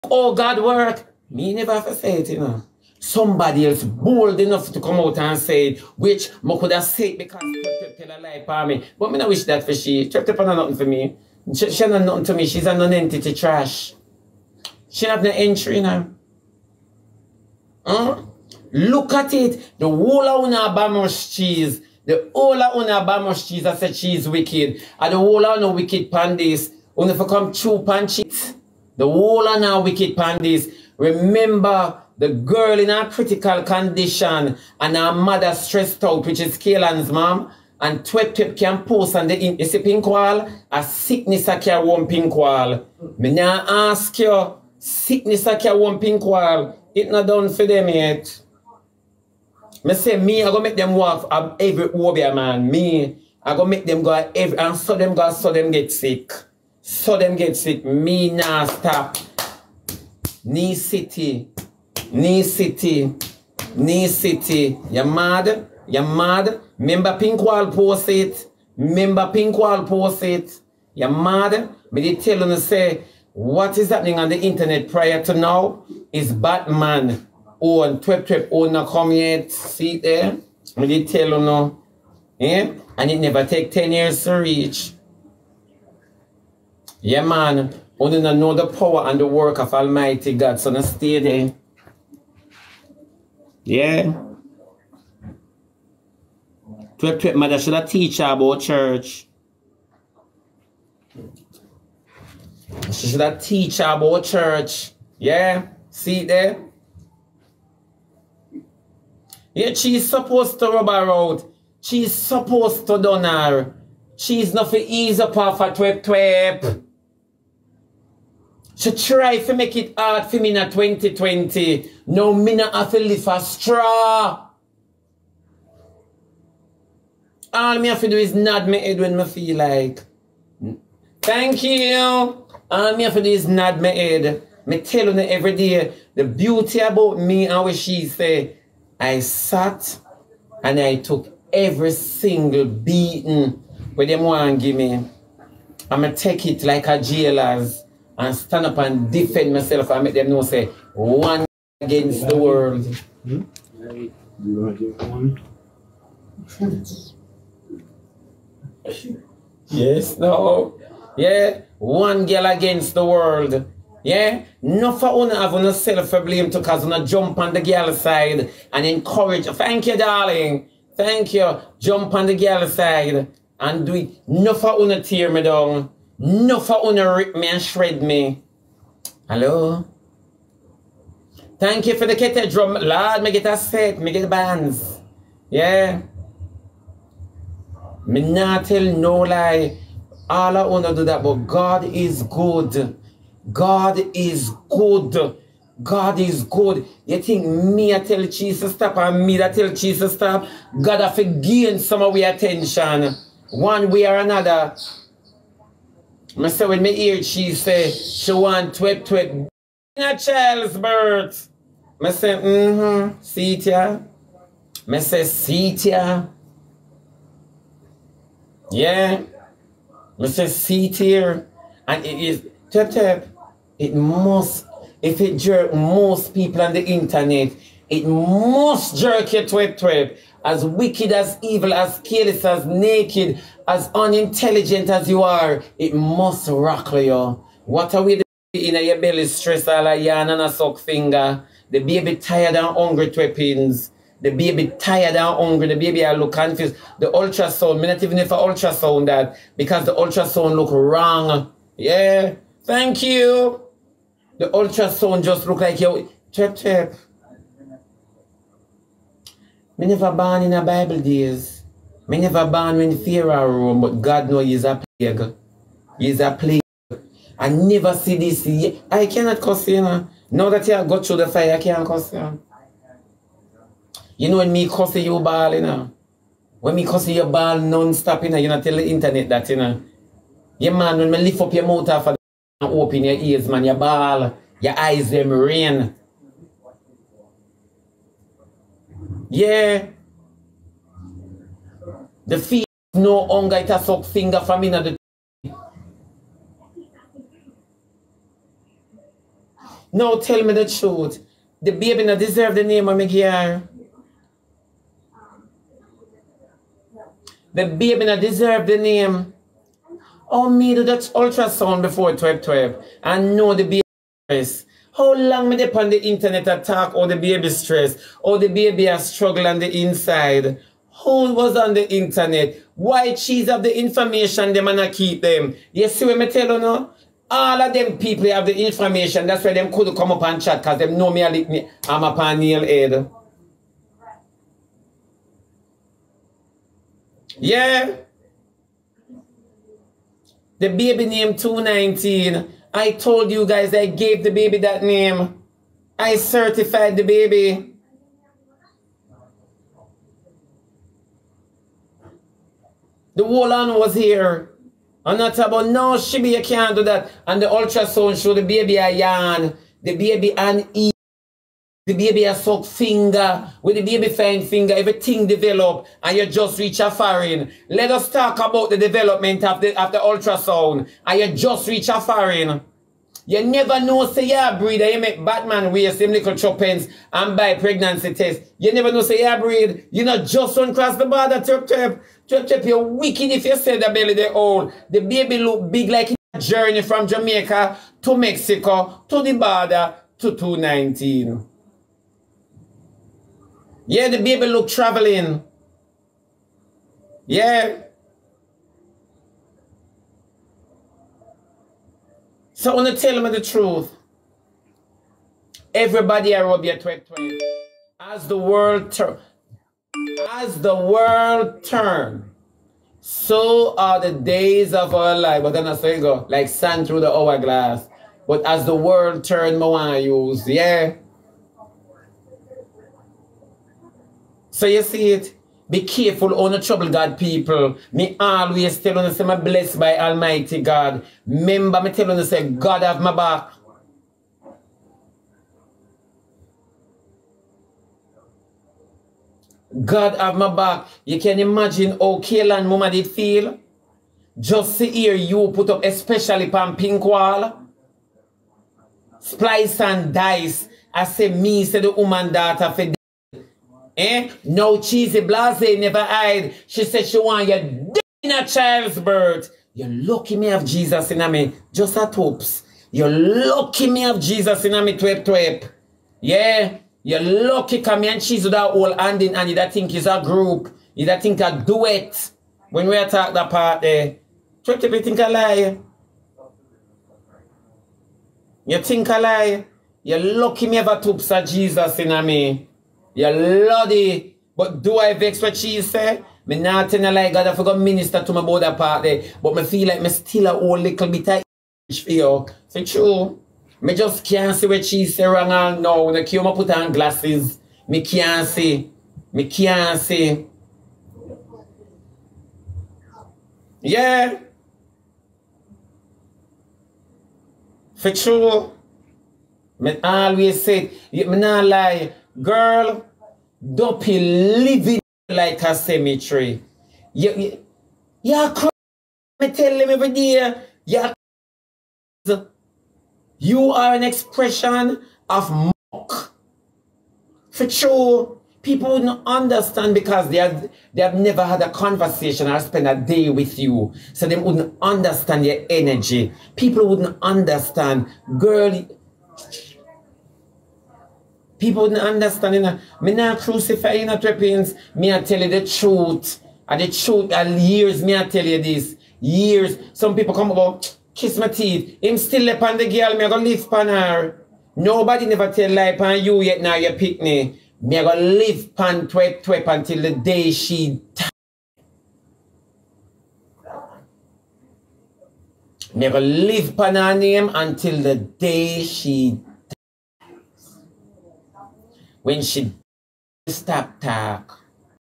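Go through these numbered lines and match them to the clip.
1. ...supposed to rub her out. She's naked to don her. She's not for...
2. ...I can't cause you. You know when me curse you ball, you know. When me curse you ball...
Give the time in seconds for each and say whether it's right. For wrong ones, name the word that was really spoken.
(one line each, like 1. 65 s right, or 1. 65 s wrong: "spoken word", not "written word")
1. 110 s wrong: "supposed", not "naked"
2. 271 s wrong: "curse", not "cause".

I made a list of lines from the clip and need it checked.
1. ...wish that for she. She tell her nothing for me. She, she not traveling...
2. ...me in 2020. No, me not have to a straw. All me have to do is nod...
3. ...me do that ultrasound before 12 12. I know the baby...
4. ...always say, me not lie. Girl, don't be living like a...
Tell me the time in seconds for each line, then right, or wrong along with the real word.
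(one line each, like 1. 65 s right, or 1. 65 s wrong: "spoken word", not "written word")
1. 9 s wrong: "nothing", not "traveling"
2. 120 s right
3. 310 s right
4. 510 s right.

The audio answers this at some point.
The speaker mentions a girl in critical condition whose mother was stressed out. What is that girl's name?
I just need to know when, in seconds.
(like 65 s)
36 s.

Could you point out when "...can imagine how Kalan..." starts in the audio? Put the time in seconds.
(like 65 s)
441 s.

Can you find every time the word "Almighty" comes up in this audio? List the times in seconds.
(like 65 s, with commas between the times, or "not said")
89 s, 429 s.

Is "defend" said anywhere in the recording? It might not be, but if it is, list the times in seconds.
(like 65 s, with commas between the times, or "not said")
149 s.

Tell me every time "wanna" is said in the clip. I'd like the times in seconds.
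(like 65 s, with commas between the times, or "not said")
190 s, 402 s.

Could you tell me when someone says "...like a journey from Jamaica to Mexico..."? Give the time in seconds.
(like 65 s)
385 s.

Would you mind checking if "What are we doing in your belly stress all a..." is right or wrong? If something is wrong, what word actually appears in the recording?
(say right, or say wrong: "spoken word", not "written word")
right.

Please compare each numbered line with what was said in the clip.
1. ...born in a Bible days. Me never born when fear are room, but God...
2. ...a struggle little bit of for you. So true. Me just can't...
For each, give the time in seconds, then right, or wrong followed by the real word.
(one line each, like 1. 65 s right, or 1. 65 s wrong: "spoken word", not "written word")
1. 260 s right
2. 490 s wrong: "whole", not "struggle".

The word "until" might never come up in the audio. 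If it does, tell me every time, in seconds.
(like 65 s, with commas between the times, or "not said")
559 s, 567 s.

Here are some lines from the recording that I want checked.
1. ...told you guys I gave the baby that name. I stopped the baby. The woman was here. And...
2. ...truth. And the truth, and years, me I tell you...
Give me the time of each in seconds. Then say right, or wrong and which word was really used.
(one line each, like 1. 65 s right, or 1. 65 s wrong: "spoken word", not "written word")
1. 342 s wrong: "certified", not "stopped"
2. 545 s right.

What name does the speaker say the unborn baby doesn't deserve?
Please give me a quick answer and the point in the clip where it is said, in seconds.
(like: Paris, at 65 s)
Miguel, at 302 s.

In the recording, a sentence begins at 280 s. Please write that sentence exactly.
Yeah, man, when me lift up your motor for, the open your ears, man, your ball, your eyes, them rain.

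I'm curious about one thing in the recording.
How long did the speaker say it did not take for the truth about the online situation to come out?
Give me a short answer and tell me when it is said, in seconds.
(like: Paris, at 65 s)
10 years, at 83 s.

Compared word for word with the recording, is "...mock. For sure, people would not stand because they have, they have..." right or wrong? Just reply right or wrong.
wrong.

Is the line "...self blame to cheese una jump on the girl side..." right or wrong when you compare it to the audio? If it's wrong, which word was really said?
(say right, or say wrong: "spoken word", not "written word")
wrong: "cause", not "cheese".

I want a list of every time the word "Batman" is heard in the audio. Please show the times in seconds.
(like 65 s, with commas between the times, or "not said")
76 s, 375 s.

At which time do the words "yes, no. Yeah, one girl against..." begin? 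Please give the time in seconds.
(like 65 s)
159 s.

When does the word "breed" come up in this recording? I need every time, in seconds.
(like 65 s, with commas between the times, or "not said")
374 s, 379 s.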